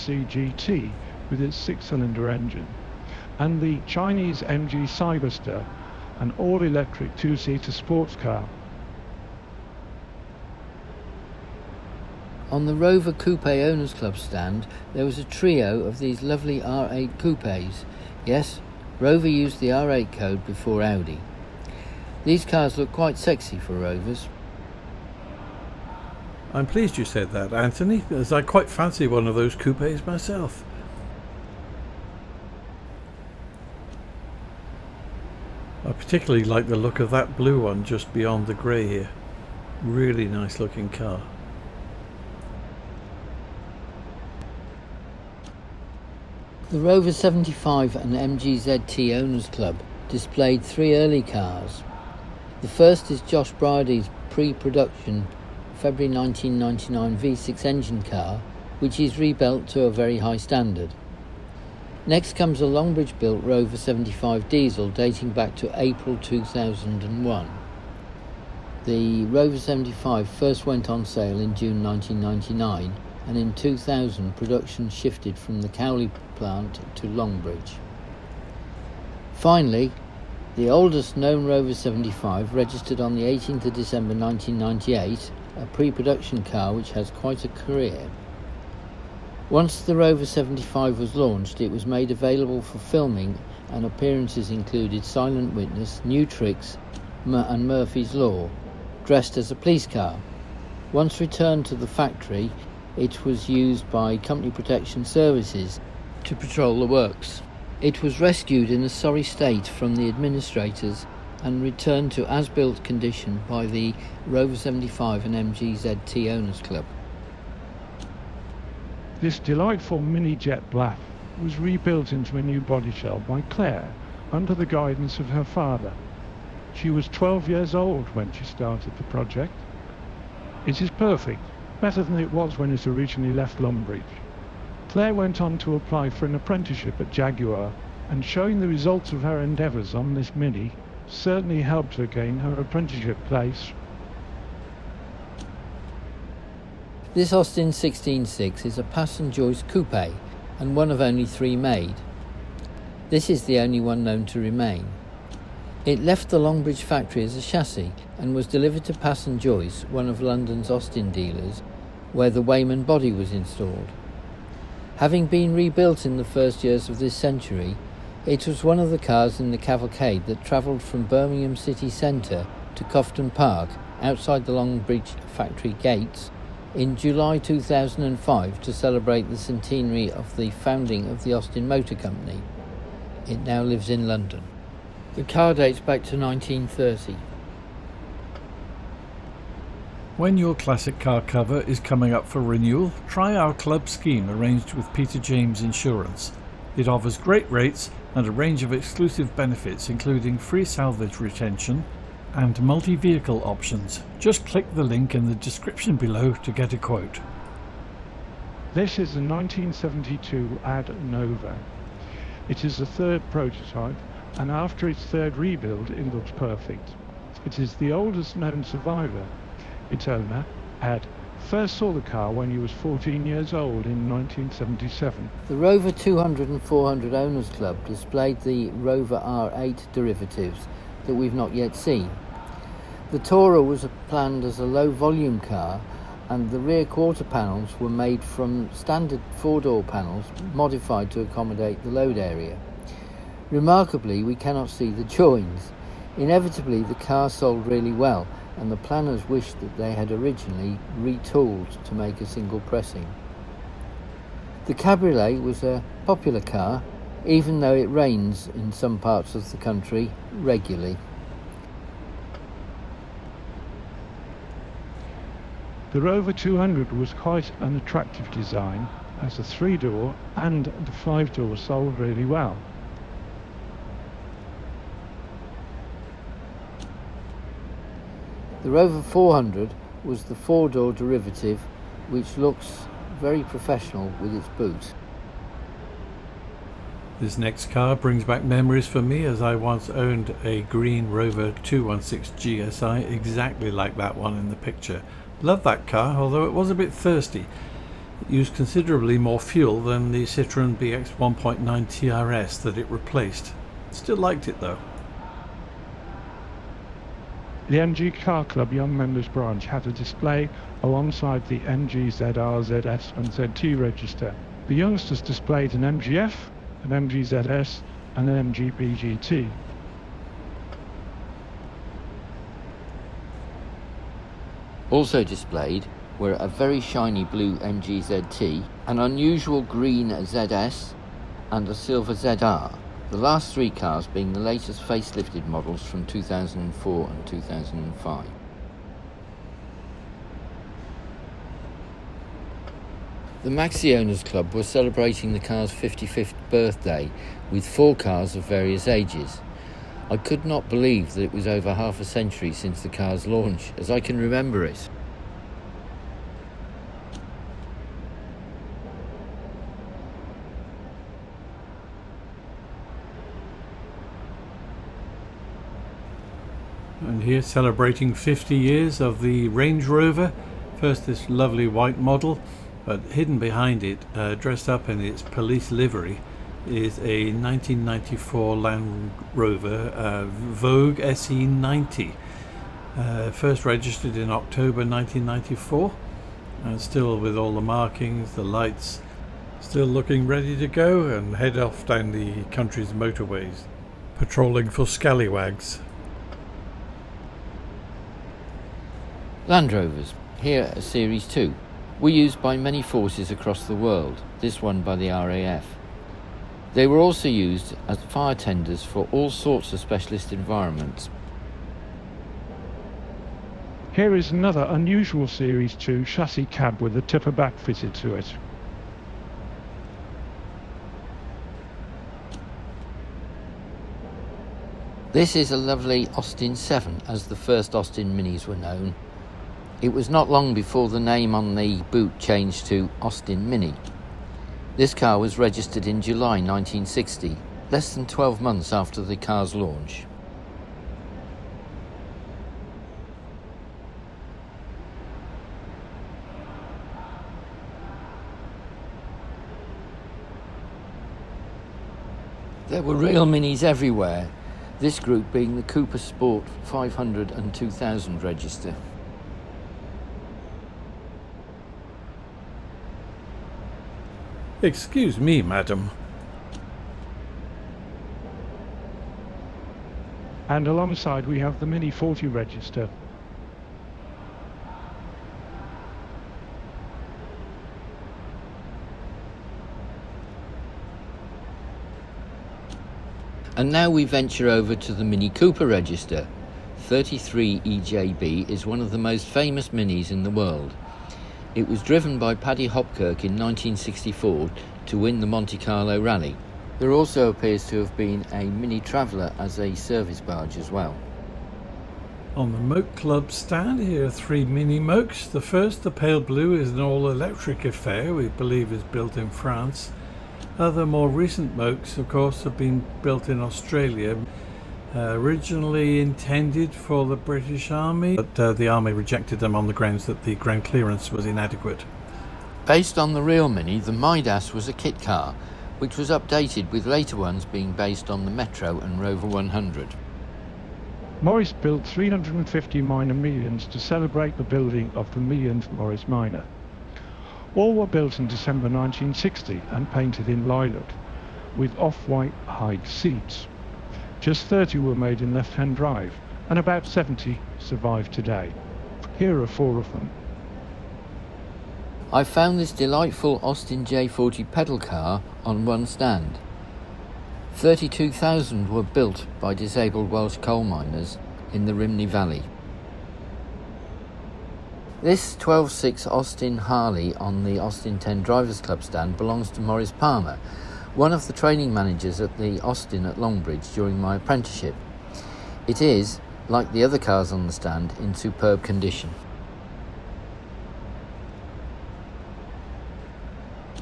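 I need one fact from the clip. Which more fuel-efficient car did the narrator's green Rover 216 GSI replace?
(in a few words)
Citroën BX 1.9 TRS.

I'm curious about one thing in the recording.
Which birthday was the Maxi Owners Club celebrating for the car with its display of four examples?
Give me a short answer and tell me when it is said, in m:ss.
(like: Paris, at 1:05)
55th, at 5:45.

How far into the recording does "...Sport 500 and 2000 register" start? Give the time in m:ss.
7:35.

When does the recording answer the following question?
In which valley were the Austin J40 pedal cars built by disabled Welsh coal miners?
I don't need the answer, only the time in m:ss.
9:21.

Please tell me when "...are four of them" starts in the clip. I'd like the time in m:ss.
9:09.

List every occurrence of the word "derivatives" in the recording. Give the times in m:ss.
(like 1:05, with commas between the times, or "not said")
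3:49, 4:40.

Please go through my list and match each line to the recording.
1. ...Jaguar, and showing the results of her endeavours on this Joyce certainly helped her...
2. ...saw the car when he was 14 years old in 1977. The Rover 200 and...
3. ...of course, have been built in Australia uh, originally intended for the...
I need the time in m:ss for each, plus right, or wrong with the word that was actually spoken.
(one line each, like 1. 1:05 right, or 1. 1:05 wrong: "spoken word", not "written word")
1. 2:17 wrong: "Mini", not "Joyce"
2. 3:41 right
3. 8:31 right.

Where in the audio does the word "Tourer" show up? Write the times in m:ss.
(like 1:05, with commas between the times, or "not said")
3:53.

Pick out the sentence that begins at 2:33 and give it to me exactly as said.
This is the only one known to remain.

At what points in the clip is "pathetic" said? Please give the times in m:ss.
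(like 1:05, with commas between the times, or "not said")
not said.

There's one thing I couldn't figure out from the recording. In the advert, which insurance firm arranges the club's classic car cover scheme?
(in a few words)
Peter James Insurance.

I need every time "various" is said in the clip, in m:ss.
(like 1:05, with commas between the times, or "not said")
5:48.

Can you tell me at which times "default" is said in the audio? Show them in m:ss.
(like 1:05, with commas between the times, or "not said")
not said.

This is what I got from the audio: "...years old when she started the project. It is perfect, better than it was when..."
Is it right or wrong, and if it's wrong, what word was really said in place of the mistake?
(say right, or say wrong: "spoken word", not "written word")
right.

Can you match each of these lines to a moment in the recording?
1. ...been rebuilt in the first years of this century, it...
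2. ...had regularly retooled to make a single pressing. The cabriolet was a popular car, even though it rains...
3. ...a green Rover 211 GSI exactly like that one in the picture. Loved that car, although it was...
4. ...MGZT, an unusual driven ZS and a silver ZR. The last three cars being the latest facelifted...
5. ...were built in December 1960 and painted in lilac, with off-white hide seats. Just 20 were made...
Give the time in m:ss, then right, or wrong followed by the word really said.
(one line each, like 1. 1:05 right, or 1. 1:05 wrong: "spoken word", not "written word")
1. 2:45 right
2. 4:09 wrong: "originally", not "regularly"
3. 4:50 wrong: "216", not "211"
4. 5:27 wrong: "green", not "driven"
5. 8:57 wrong: "30", not "20".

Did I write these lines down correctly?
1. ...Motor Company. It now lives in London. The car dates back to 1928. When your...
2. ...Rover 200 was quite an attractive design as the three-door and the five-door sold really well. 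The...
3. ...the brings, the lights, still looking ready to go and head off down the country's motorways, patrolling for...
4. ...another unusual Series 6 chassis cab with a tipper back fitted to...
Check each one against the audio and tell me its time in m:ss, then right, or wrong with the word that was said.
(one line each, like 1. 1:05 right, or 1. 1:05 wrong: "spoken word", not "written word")
1. 3:01 wrong: "1930", not "1928"
2. 4:26 right
3. 6:27 wrong: "markings", not "brings"
4. 6:54 wrong: "2", not "6".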